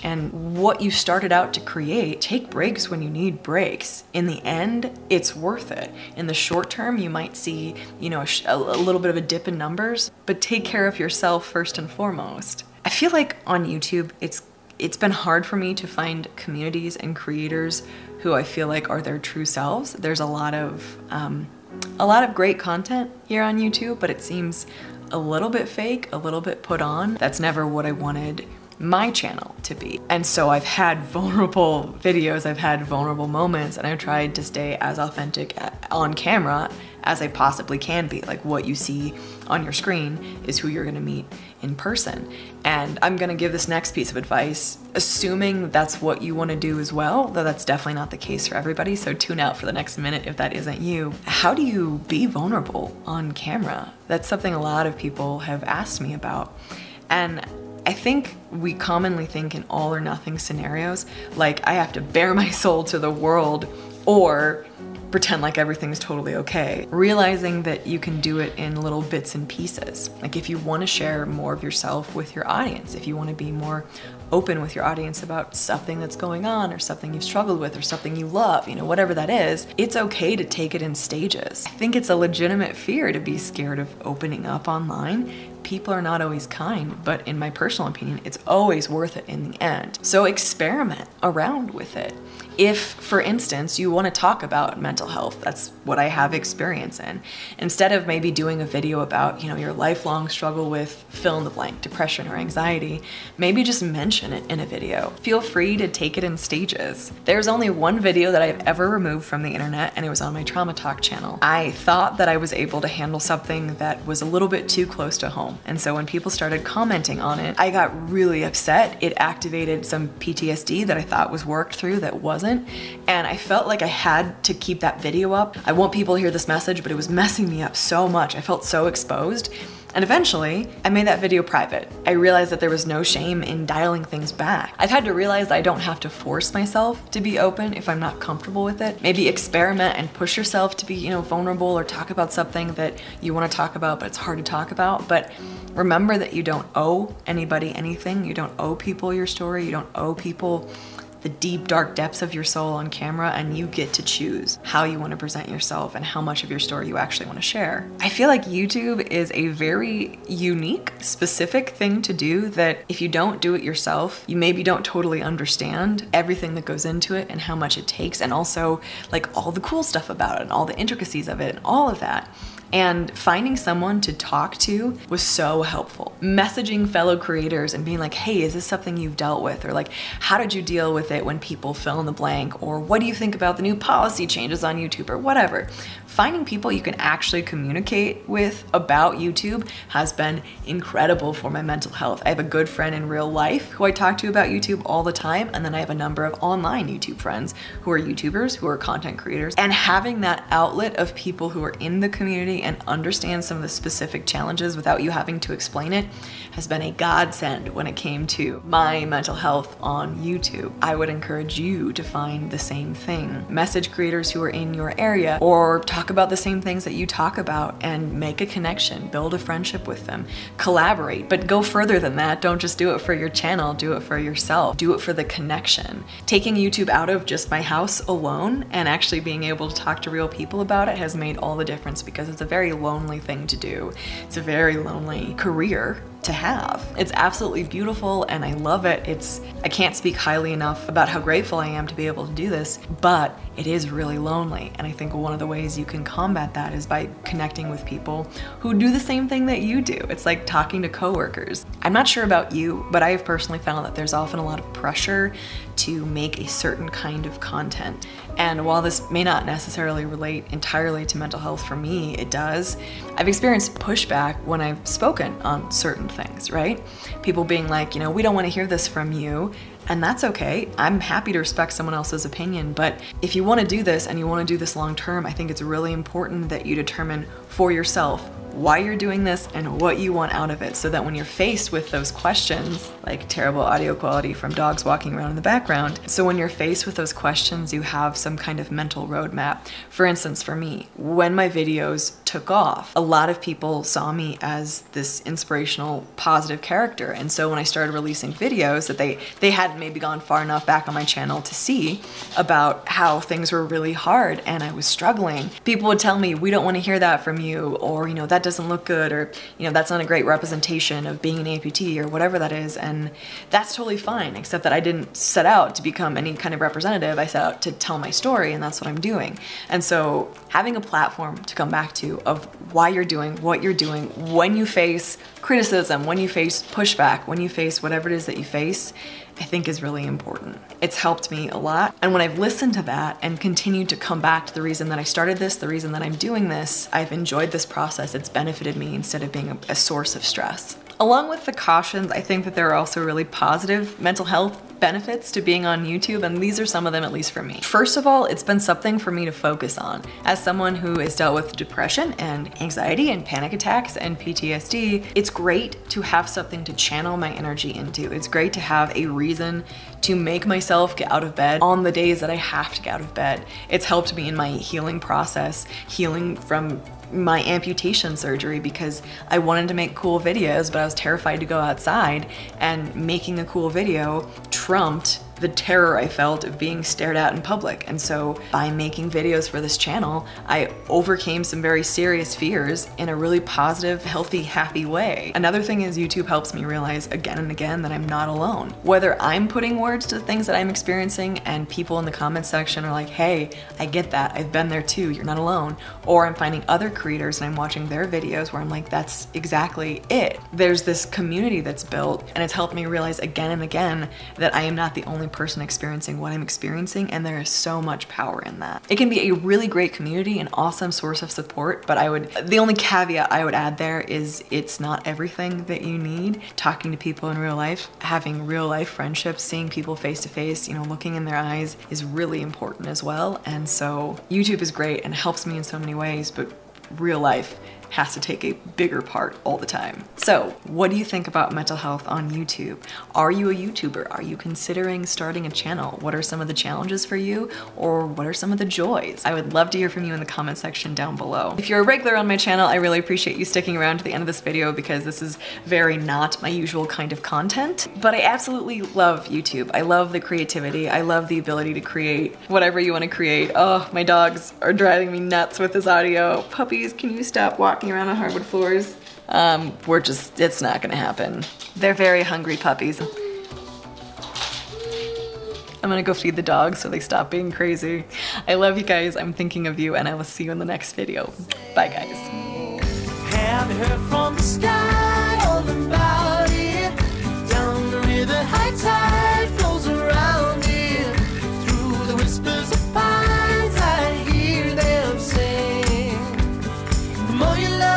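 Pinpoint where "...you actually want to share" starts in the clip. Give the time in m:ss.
2:36.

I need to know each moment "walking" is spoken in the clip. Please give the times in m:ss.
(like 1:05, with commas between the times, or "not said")
4:44, 7:37.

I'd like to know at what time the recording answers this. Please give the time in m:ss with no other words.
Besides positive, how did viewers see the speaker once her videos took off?
4:55.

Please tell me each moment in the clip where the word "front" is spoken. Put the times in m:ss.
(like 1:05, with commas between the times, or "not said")
not said.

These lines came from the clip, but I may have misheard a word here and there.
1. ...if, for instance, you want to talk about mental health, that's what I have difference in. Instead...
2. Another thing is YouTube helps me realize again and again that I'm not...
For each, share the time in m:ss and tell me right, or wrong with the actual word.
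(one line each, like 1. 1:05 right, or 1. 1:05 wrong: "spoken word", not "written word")
1. 1:32 wrong: "experience", not "difference"
2. 6:25 right.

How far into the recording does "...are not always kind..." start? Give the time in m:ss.
1:25.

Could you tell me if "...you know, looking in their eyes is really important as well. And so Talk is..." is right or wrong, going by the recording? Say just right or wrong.
wrong.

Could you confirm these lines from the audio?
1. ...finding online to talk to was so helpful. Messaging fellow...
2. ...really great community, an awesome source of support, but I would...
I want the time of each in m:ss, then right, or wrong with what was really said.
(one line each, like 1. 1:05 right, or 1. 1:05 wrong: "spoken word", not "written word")
1. 2:53 wrong: "someone", not "online"
2. 6:49 right.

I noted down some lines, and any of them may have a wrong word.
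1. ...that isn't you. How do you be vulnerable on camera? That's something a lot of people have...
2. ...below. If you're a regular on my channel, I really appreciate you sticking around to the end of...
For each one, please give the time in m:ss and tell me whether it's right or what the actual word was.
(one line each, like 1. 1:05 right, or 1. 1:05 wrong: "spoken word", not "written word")
1. 0:50 right
2. 7:21 right.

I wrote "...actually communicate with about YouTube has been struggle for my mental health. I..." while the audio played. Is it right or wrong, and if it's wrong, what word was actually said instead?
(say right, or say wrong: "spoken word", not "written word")
wrong: "incredible", not "struggle".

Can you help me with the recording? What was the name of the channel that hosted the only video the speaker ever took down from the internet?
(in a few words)
Trauma Talk.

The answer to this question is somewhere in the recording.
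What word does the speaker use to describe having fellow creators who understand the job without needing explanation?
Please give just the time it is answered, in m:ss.
3:26.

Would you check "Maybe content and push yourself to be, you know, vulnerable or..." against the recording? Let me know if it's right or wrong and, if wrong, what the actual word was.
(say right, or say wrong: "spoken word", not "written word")
wrong: "experiment", not "content".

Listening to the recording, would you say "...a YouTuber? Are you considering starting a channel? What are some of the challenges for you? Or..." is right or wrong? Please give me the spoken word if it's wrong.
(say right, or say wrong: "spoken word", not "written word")
right.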